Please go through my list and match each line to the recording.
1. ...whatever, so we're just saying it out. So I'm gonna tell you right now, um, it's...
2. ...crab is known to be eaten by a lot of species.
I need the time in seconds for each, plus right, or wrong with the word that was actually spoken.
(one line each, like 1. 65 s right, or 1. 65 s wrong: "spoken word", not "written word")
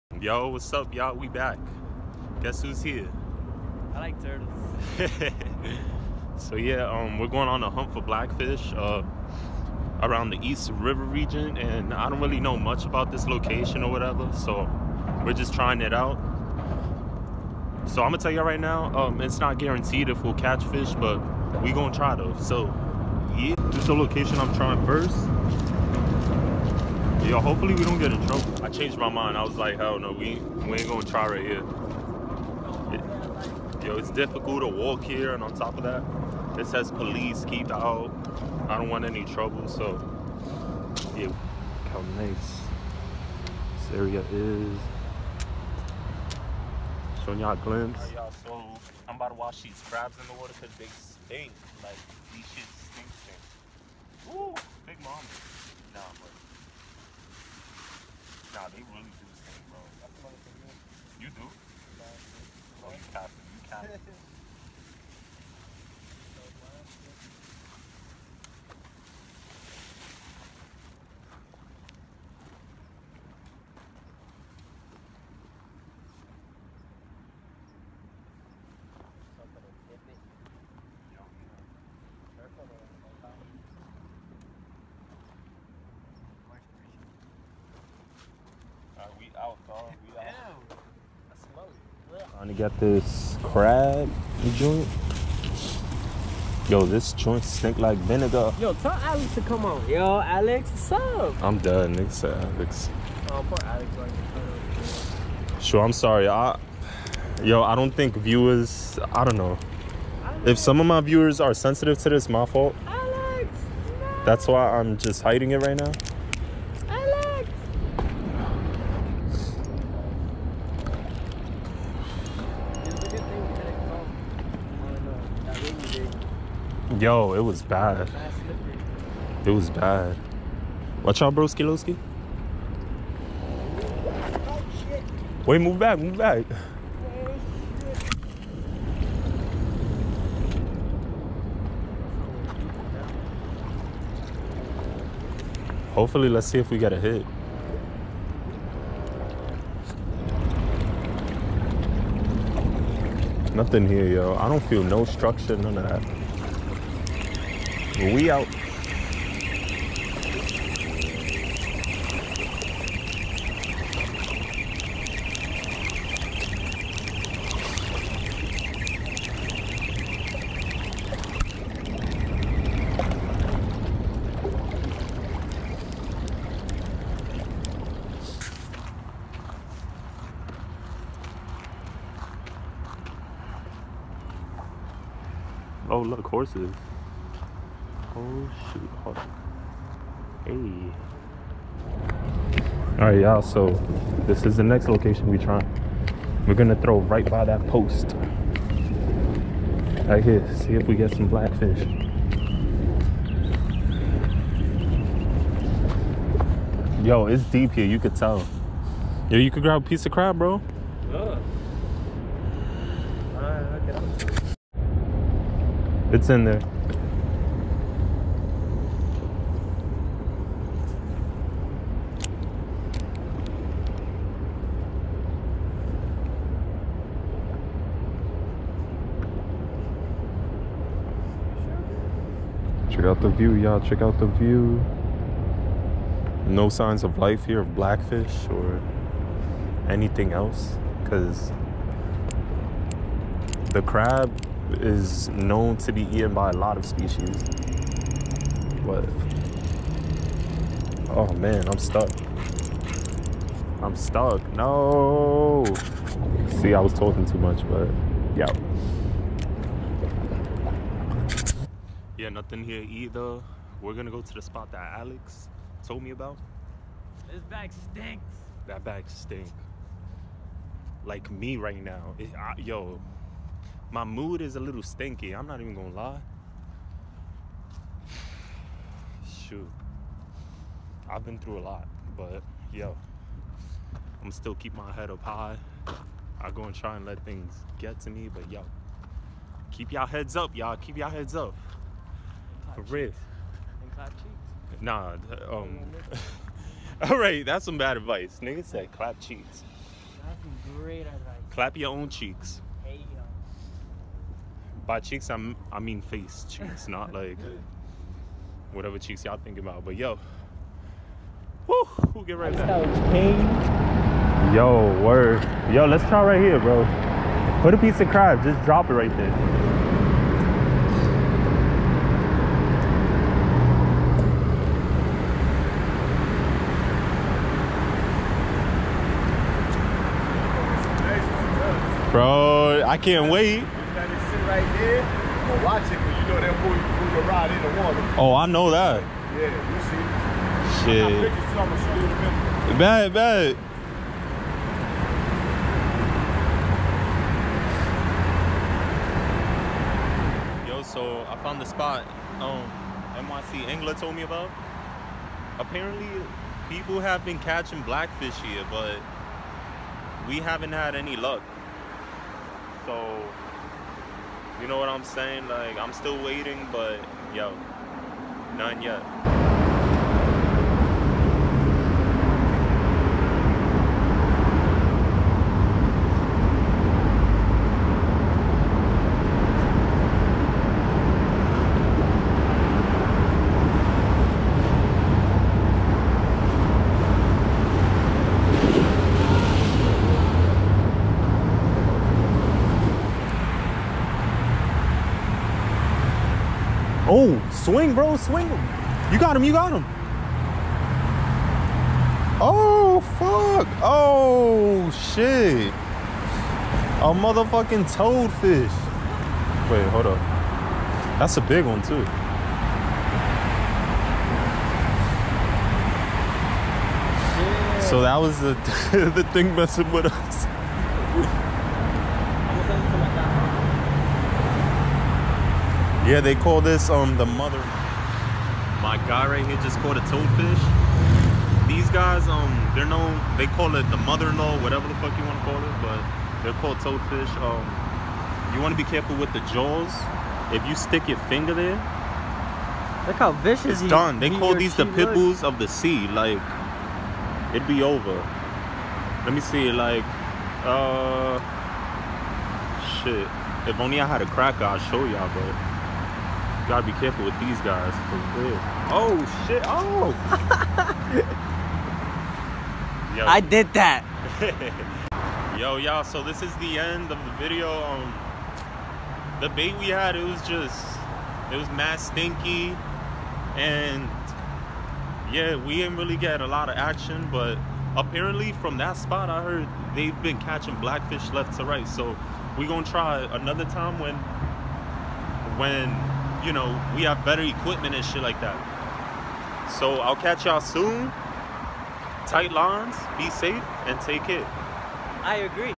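1. 13 s wrong: "trying", not "saying"
2. 243 s right.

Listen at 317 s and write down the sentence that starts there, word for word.
Put a piece of crab, just drop it right there.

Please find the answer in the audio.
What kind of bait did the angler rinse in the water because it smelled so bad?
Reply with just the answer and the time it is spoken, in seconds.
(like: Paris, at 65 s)
Crabs, at 49 s.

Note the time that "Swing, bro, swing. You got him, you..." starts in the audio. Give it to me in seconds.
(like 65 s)
397 s.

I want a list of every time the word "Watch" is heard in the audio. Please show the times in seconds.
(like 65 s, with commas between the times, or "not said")
131 s.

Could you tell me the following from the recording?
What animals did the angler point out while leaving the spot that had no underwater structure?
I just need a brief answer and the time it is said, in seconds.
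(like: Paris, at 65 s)
Horses, at 186 s.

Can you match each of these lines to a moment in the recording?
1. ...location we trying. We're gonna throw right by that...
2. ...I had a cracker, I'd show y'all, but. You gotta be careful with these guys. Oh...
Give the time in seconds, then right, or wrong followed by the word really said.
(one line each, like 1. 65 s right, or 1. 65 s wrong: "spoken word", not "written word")
1. 194 s right
2. 454 s right.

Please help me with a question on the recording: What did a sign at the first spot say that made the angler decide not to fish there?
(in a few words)
Police keep out.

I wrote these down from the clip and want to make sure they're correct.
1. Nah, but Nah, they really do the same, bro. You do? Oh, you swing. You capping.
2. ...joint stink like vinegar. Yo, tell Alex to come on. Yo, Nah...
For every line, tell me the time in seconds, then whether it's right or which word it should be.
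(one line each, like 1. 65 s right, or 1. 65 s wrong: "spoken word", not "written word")
1. 55 s wrong: "capping", not "swing"
2. 97 s wrong: "Alex", not "Nah".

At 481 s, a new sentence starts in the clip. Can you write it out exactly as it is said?
So we're gonna try another time when when you know, we have better equipment and shit like that.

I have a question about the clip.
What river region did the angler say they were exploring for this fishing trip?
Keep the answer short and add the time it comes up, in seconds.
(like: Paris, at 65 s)
East River, at 10 s.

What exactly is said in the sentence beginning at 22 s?
So yeah, this is the location I'm trying first.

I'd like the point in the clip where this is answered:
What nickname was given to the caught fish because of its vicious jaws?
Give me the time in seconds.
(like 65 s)
444 s.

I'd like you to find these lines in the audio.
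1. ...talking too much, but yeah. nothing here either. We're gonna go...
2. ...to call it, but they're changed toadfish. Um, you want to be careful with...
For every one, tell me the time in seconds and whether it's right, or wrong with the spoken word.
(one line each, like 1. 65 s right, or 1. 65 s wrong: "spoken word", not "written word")
1. 256 s right
2. 435 s wrong: "called", not "changed".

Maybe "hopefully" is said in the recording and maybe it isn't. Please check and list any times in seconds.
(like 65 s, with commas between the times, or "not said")
27 s, 145 s.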